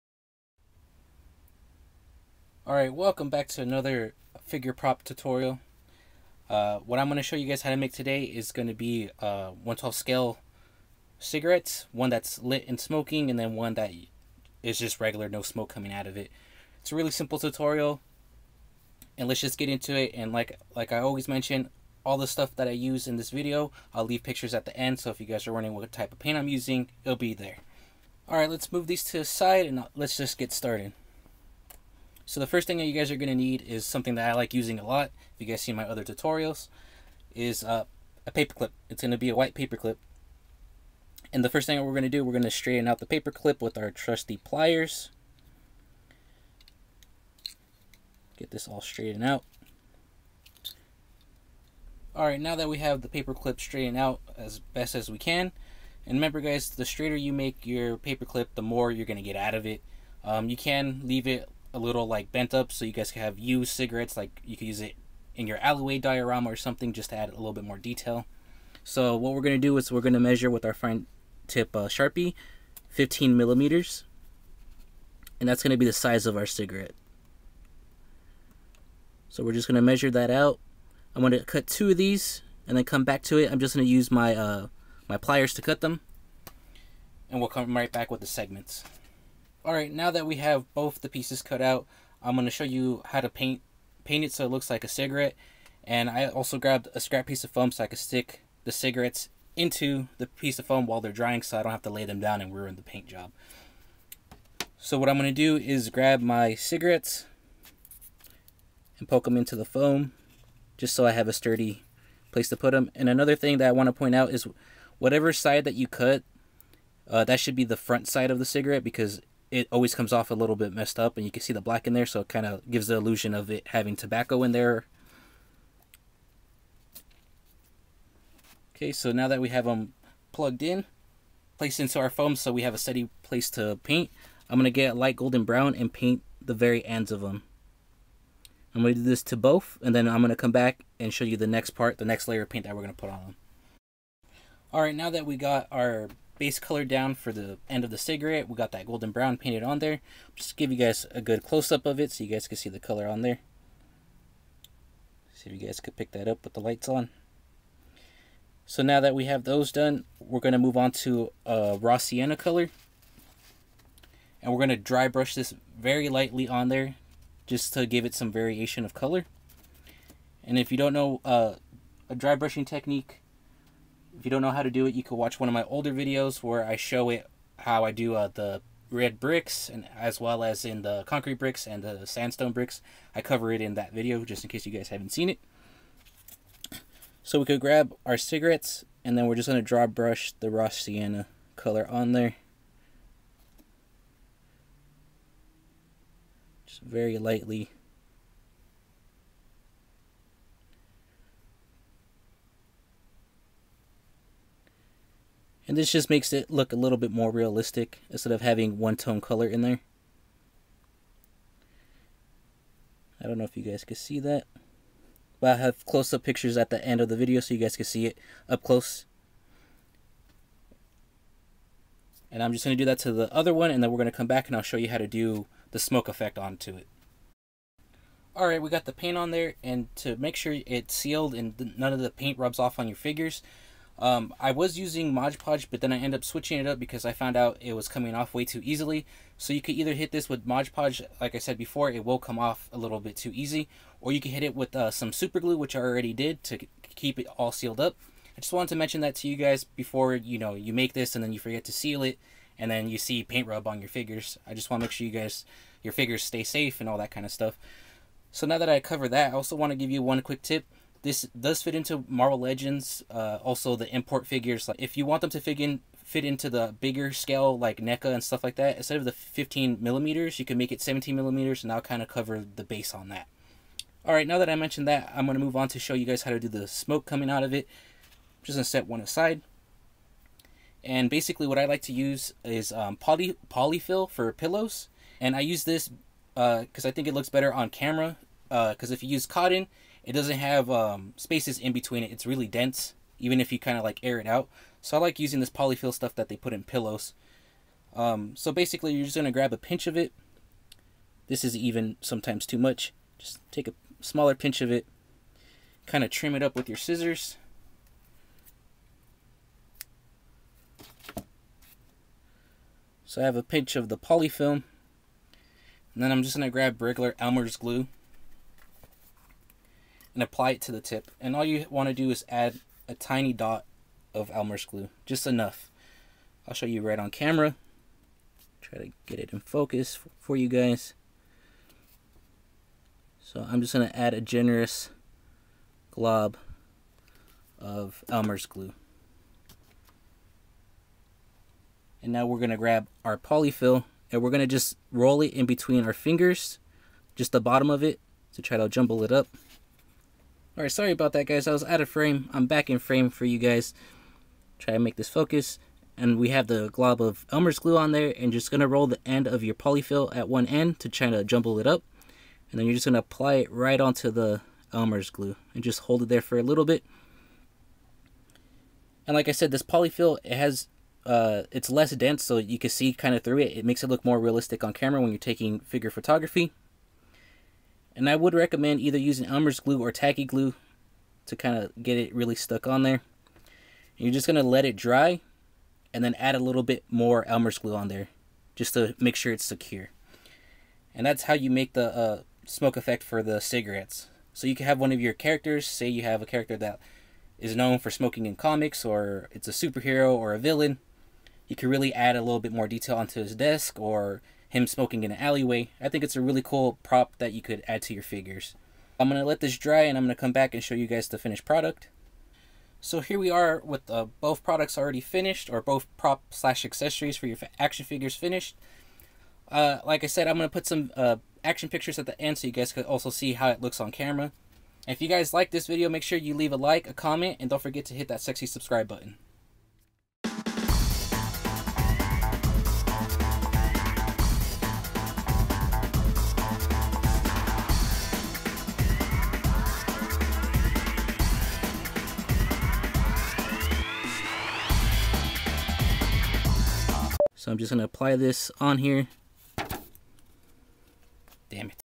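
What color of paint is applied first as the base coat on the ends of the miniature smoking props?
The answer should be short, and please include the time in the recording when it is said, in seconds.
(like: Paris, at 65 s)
light golden brown, at 134 s.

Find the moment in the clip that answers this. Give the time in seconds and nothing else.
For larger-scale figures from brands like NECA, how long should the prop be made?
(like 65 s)
270 s.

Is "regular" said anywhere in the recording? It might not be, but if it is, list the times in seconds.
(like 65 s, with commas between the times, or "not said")
15 s, 316 s.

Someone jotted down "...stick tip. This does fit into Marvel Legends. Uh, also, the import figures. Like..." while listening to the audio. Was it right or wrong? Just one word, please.
wrong.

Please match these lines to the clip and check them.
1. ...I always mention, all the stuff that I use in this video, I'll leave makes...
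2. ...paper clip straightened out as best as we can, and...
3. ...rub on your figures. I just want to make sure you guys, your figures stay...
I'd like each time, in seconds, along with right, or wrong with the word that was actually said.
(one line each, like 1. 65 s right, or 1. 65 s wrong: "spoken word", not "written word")
1. 20 s wrong: "pictures", not "makes"
2. 53 s right
3. 253 s right.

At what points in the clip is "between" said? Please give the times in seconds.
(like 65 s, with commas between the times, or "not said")
291 s, 345 s.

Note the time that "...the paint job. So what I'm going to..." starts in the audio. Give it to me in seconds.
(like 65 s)
102 s.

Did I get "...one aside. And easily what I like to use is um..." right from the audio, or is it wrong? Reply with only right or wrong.
wrong.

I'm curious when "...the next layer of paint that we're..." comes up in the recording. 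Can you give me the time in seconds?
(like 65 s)
141 s.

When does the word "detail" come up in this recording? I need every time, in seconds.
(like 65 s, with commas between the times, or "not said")
67 s, 402 s.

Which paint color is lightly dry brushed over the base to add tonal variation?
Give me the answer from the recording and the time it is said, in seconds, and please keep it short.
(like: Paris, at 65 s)
raw sienna, at 161 s.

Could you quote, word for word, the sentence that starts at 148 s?
We got that golden brown painted on there.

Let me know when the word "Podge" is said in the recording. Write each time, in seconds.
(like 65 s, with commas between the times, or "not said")
235 s, 240 s.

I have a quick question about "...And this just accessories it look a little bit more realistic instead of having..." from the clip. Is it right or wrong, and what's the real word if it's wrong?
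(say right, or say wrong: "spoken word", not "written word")
wrong: "makes", not "accessories".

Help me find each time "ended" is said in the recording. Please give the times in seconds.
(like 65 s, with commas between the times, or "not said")
235 s.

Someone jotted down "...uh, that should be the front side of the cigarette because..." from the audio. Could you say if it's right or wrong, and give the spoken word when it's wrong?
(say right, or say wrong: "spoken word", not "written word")
right.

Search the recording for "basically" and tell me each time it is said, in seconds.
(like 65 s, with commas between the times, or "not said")
281 s, 298 s.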